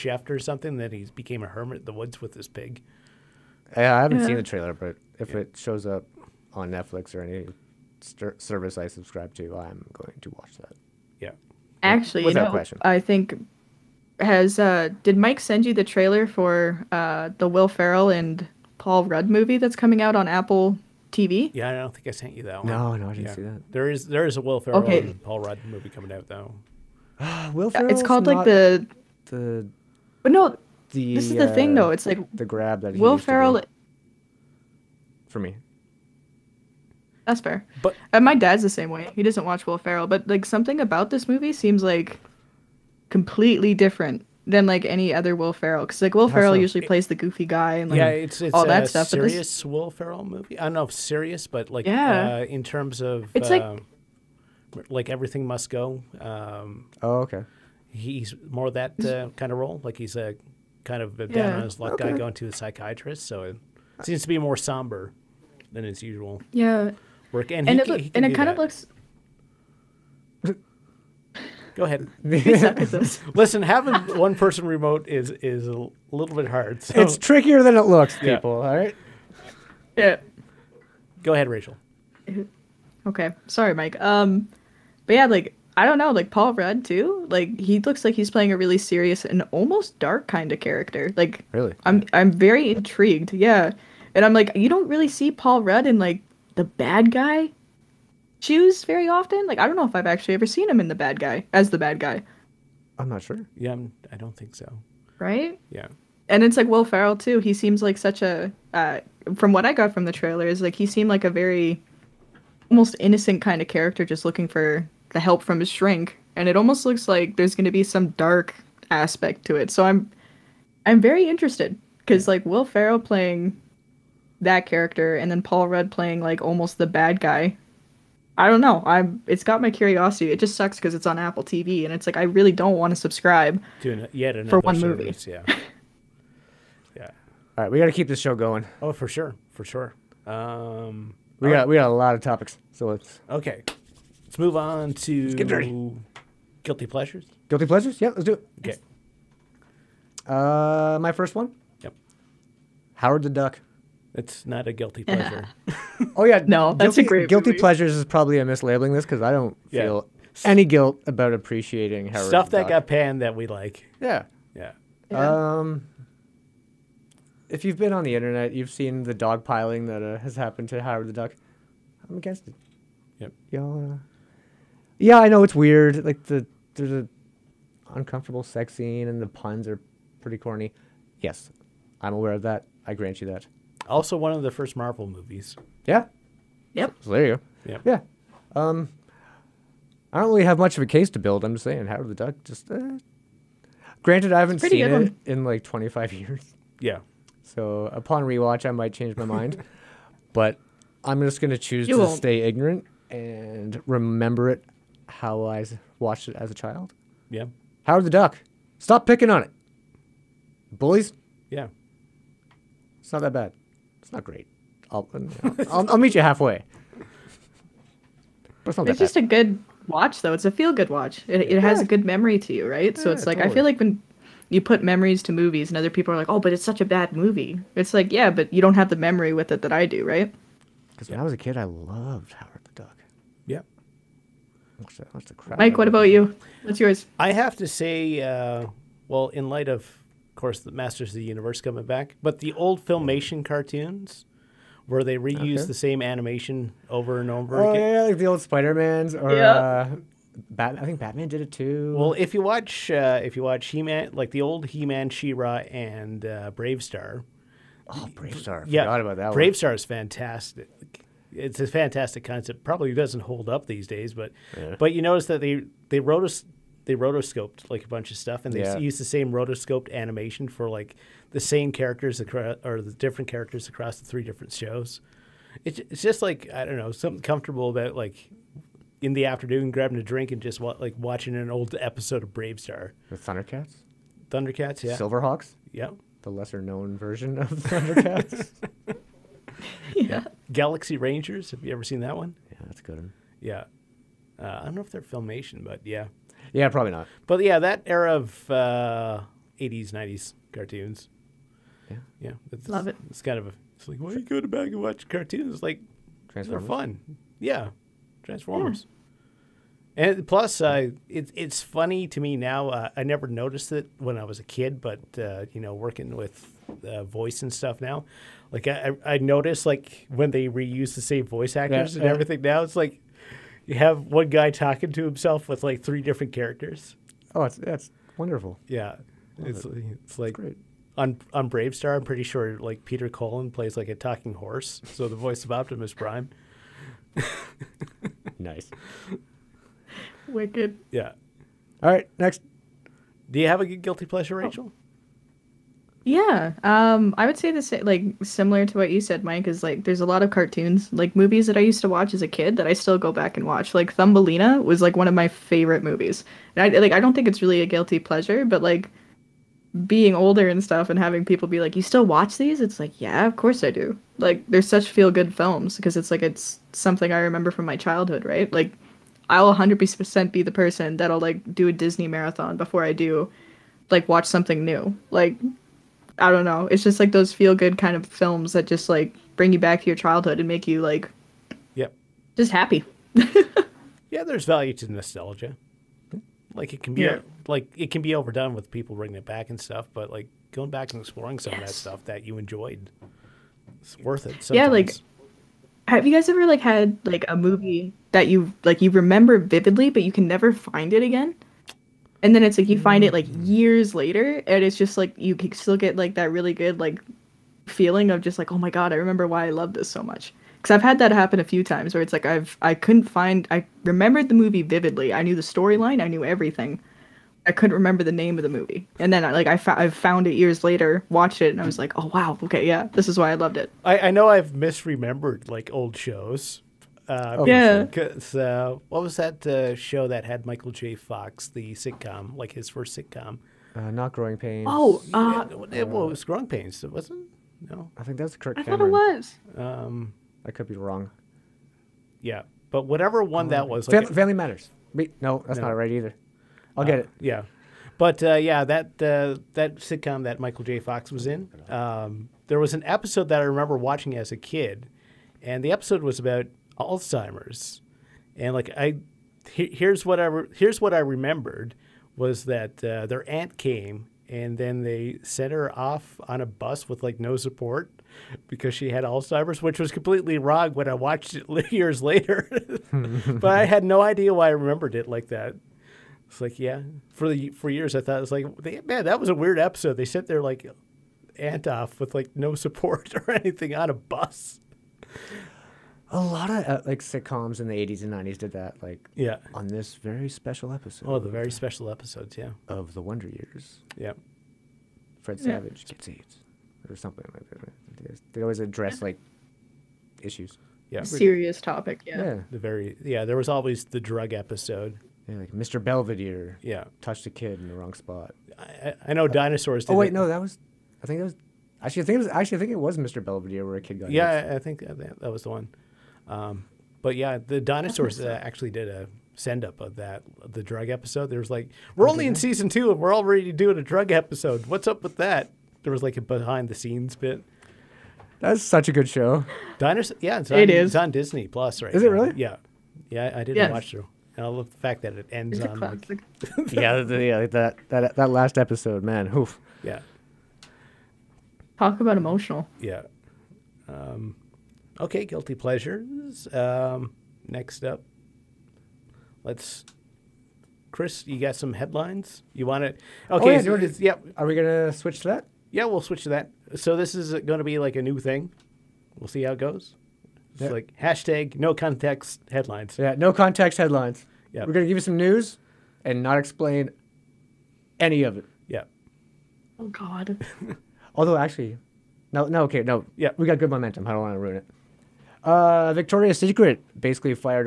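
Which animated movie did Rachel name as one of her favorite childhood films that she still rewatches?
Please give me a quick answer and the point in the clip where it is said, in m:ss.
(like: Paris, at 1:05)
Thumbelina, at 5:53.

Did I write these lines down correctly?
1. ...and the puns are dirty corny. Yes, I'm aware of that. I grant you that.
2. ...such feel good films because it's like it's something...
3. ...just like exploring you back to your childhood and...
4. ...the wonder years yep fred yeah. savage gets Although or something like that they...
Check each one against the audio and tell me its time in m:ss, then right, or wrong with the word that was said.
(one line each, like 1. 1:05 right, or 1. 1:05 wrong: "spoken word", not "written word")
1. 2:59 wrong: "pretty", not "dirty"
2. 6:04 right
3. 6:18 wrong: "bring", not "exploring"
4. 8:12 wrong: "AIDS", not "Although".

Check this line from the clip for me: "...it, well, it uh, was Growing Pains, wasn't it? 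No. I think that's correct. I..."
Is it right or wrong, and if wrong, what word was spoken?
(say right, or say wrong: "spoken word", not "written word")
right.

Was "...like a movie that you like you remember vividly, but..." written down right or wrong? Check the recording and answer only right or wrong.
right.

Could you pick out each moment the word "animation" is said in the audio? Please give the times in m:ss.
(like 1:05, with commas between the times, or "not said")
4:06, 4:29.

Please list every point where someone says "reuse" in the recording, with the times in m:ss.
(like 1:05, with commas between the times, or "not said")
4:05, 5:20.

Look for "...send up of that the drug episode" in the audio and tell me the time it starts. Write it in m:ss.
8:39.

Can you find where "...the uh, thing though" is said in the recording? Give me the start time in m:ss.
0:31.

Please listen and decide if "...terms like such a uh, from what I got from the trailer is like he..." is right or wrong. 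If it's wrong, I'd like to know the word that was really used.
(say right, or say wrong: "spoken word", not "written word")
wrong: "seems", not "terms".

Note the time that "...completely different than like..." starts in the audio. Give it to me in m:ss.
0:43.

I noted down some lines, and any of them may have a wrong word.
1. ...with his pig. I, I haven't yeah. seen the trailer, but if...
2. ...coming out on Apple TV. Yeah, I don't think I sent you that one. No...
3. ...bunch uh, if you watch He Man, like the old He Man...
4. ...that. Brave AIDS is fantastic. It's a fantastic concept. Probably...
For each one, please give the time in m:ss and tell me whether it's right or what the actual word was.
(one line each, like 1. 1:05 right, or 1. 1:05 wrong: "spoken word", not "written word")
1. 0:02 right
2. 0:19 right
3. 4:12 wrong: "watch", not "bunch"
4. 4:19 wrong: "Star", not "AIDS".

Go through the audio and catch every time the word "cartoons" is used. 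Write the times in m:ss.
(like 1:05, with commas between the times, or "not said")
4:03, 5:00, 5:05, 5:50.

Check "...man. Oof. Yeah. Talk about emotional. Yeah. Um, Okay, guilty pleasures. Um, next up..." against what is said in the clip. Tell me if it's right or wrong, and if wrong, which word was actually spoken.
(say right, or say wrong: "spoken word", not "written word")
right.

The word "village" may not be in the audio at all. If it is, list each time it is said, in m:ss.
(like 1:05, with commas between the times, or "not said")
not said.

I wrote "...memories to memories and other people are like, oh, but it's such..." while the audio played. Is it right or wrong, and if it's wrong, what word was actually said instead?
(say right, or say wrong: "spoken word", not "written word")
wrong: "movies", not "memories".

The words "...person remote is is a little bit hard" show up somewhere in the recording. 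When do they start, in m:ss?
1:14.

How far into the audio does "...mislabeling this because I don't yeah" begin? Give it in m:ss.
2:38.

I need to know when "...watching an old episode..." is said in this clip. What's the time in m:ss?
4:40.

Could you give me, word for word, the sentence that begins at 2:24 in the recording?
Let's move on to let's get dirty.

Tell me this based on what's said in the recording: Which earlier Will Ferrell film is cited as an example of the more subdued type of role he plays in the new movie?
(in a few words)
Everything Must Go.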